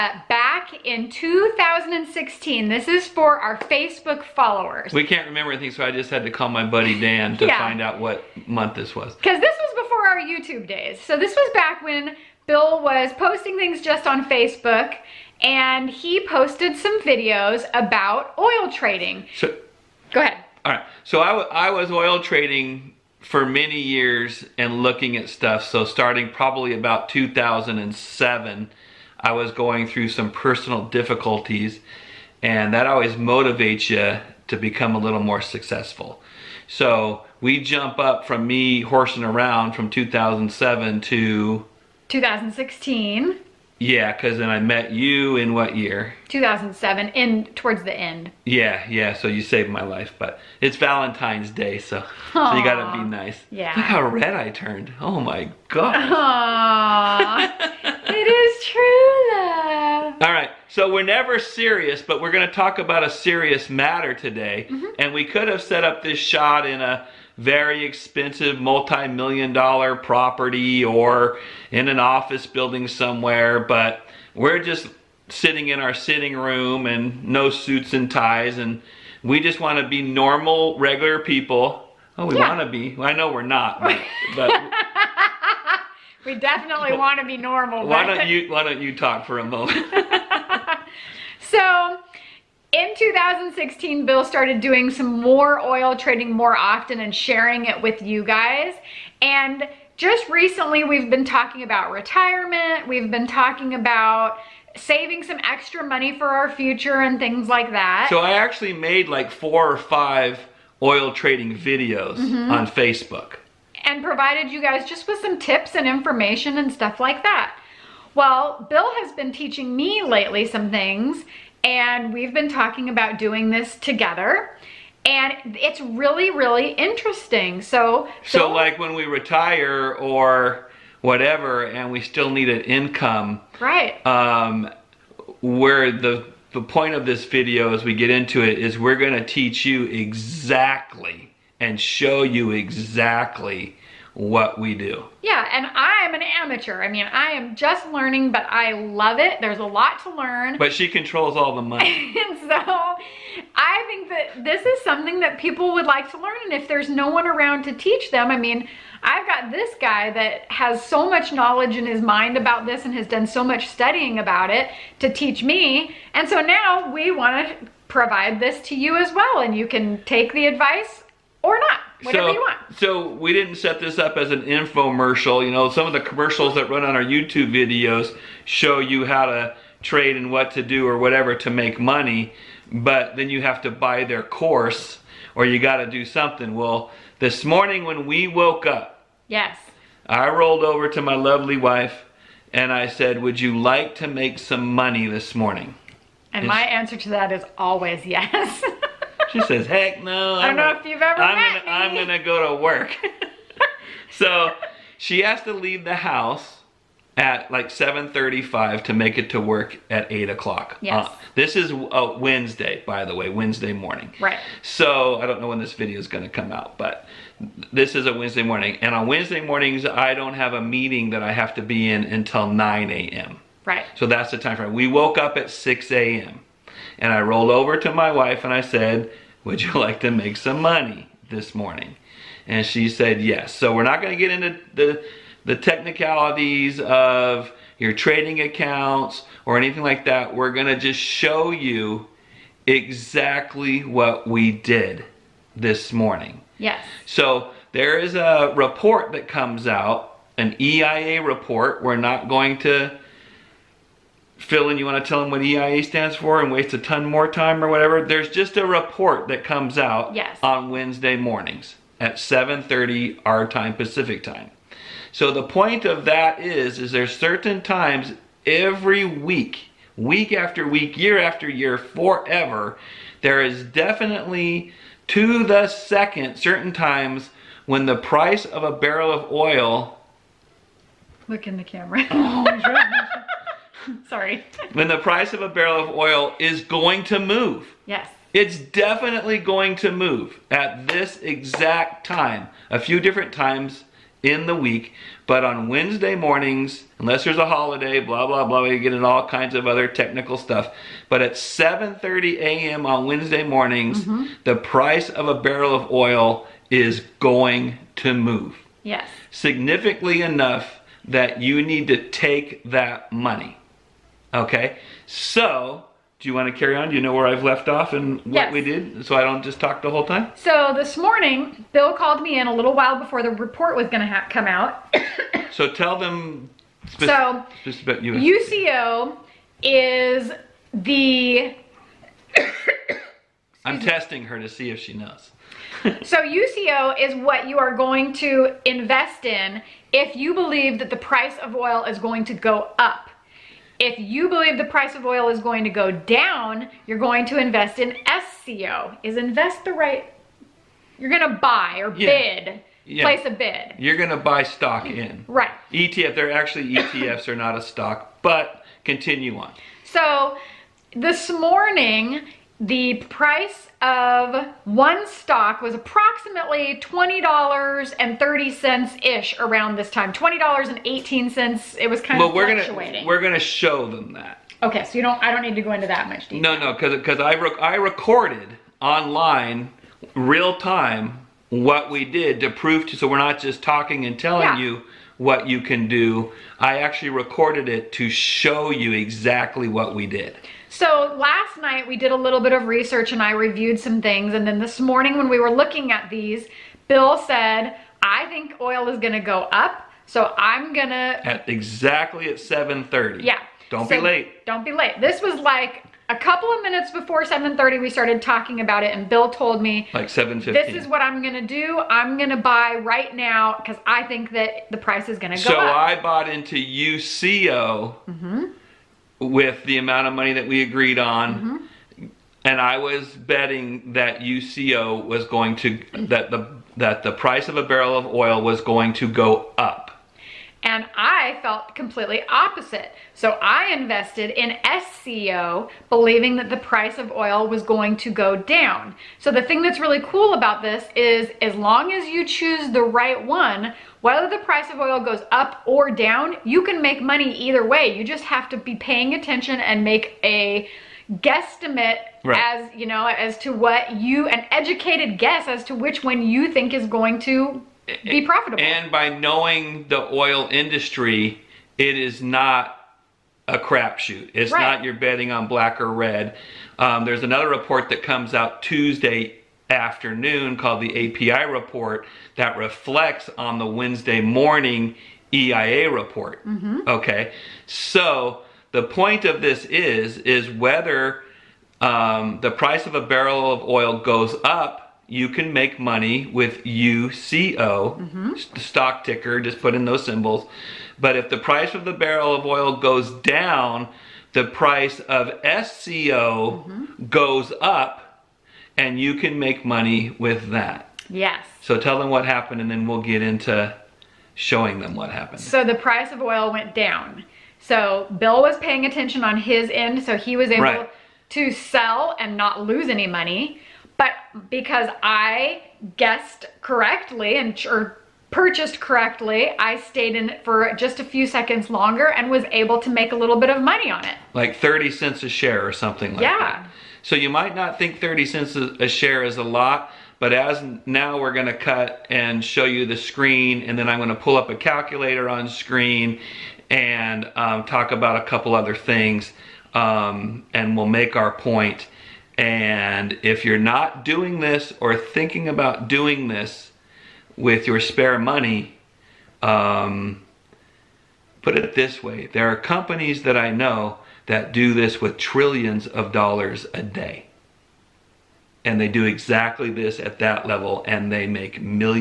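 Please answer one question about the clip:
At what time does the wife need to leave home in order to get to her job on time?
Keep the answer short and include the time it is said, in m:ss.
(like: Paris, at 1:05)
7:35, at 3:27.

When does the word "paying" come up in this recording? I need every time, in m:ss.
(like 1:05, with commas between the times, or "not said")
7:28, 8:28.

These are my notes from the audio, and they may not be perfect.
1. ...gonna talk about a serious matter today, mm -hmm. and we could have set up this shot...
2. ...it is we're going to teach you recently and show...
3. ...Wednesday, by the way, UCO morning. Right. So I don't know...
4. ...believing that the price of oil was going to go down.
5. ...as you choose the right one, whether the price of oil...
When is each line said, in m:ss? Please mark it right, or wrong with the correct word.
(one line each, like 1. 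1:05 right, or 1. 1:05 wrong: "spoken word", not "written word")
1. 1:02 right
2. 2:18 wrong: "exactly", not "recently"
3. 3:32 wrong: "Wednesday", not "UCO"
4. 7:15 right
5. 7:21 right.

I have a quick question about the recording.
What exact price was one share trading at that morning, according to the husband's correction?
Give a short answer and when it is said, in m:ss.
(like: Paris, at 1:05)
$20.18, at 6:10.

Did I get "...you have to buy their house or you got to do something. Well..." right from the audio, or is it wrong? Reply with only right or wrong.
wrong.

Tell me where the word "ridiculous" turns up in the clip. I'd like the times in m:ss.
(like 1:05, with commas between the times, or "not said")
not said.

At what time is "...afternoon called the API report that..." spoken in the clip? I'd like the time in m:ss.
7:49.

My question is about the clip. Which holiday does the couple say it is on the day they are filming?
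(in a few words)
Valentine's Day.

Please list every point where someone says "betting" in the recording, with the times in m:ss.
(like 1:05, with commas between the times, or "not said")
7:03, 7:44.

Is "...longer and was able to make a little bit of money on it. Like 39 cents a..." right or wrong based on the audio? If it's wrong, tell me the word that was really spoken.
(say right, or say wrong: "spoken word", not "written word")
wrong: "30", not "39".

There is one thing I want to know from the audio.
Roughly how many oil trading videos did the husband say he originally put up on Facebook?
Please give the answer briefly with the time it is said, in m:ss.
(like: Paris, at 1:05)
4 or 5, at 1:49.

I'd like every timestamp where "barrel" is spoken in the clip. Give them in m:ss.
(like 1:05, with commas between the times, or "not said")
4:38, 4:45, 5:05, 7:07, 8:03, 8:11.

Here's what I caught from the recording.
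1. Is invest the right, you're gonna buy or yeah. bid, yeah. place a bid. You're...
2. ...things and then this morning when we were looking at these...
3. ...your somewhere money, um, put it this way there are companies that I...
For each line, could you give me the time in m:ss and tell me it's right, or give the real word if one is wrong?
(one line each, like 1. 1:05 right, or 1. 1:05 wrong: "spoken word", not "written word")
1. 5:49 right
2. 6:34 right
3. 9:07 wrong: "spare", not "somewhere".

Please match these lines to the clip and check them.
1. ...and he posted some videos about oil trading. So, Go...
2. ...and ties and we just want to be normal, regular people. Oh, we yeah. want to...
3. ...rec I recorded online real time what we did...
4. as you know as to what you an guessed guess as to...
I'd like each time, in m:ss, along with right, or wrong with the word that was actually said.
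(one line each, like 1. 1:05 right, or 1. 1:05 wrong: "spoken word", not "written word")
1. 0:15 right
2. 1:17 right
3. 6:17 right
4. 7:32 wrong: "educated", not "guessed".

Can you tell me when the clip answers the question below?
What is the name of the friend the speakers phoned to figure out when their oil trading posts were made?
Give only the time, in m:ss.
0:06.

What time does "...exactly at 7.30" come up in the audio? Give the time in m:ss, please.
6:41.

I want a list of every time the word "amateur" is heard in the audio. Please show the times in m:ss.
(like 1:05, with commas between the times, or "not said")
2:26.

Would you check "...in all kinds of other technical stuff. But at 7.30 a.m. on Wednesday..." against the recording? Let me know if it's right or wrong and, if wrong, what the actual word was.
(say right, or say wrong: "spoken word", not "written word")
right.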